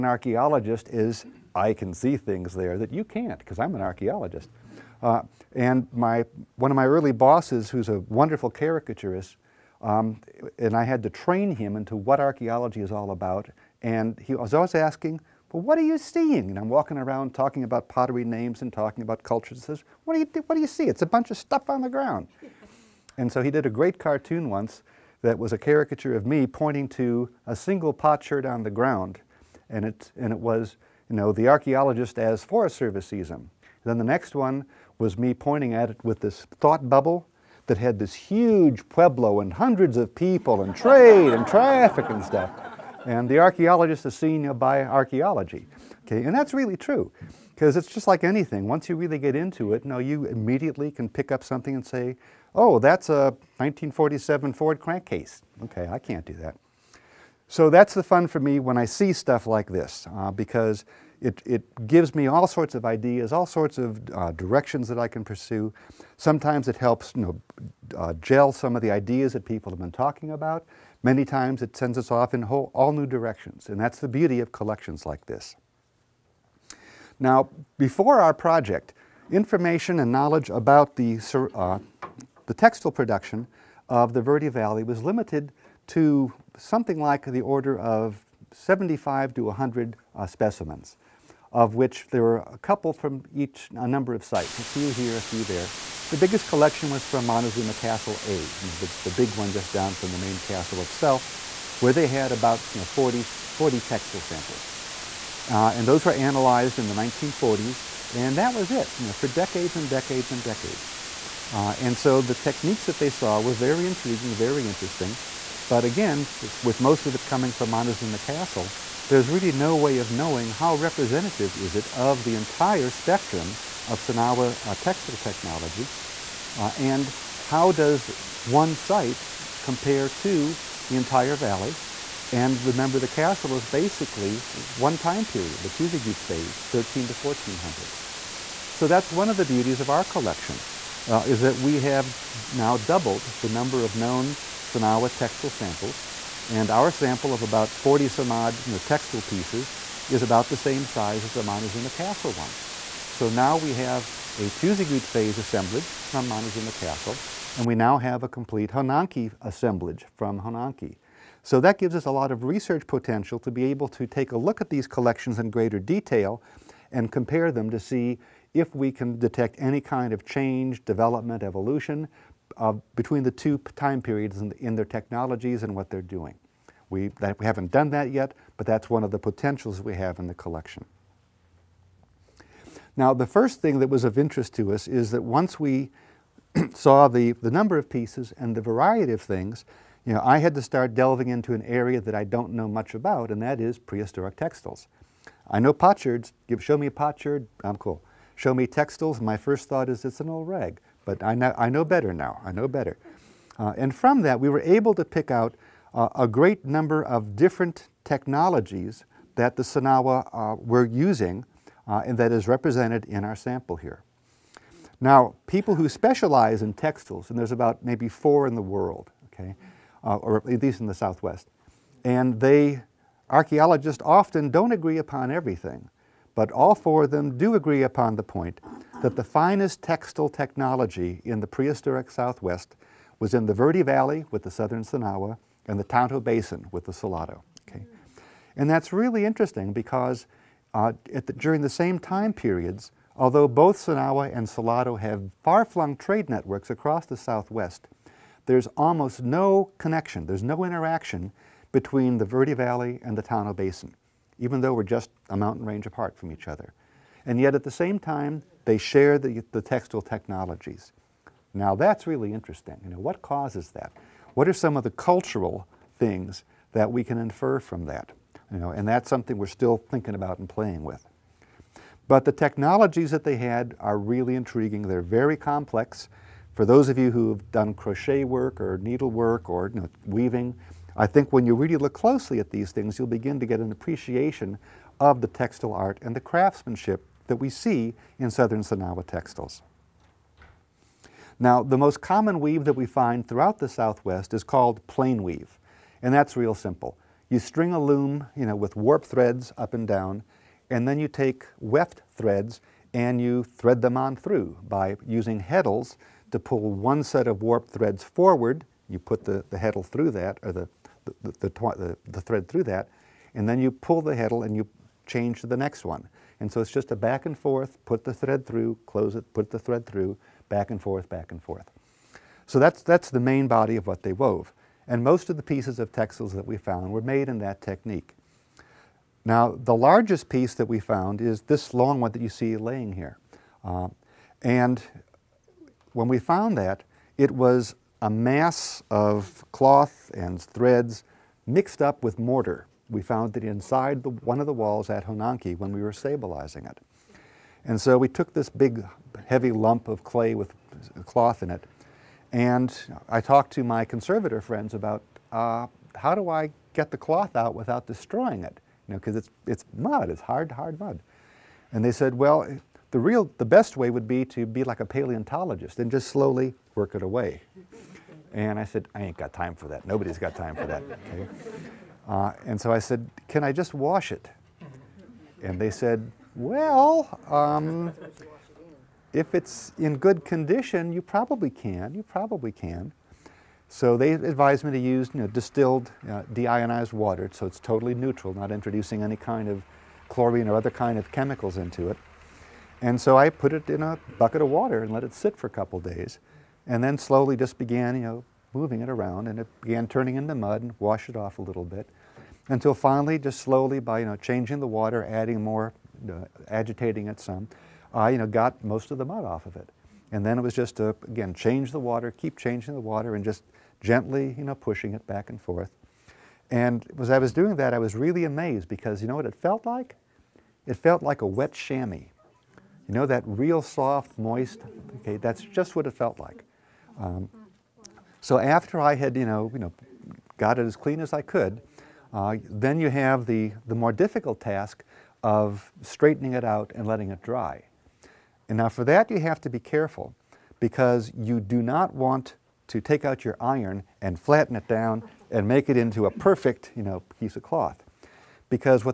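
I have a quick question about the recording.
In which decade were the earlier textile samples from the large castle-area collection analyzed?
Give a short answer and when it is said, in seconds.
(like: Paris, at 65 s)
1940s, at 106 s.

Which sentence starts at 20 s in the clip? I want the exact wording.
It's a bunch of stuff on the ground.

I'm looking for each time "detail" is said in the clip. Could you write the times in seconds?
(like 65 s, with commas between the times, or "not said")
165 s.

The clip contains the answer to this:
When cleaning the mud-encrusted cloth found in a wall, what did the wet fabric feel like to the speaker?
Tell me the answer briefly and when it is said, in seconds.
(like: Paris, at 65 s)
A wet chamois, at 421 s.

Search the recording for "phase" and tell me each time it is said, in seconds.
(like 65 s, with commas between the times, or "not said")
136 s, 155 s.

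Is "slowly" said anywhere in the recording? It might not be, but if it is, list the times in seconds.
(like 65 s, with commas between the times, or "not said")
366 s, 396 s, 403 s.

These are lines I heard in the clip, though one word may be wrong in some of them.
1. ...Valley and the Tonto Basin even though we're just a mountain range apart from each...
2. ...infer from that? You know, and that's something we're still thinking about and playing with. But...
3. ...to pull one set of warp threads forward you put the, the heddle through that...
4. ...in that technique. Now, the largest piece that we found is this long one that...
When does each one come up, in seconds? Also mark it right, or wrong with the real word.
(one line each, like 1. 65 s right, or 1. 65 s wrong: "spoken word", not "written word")
1. 252 s right
2. 267 s right
3. 306 s right
4. 327 s right.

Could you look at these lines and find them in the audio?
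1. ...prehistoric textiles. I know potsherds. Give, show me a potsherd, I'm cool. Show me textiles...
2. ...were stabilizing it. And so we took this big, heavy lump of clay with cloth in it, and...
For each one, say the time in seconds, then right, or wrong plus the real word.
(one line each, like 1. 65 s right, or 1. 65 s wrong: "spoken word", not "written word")
1. 193 s right
2. 345 s right.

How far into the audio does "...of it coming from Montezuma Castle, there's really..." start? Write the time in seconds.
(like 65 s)
117 s.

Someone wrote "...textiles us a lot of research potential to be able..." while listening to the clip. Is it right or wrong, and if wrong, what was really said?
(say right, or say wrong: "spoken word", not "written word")
wrong: "gives", not "textiles".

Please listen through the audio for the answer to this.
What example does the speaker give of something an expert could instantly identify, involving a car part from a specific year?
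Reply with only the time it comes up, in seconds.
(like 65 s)
53 s.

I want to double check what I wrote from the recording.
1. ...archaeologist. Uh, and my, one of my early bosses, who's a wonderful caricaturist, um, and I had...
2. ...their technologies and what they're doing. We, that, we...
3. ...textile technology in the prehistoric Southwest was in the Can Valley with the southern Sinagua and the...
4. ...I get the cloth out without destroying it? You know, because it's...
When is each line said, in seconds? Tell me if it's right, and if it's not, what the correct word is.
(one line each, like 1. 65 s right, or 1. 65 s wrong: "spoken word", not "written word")
1. 3 s right
2. 174 s right
3. 229 s wrong: "Verde", not "Can"
4. 356 s right.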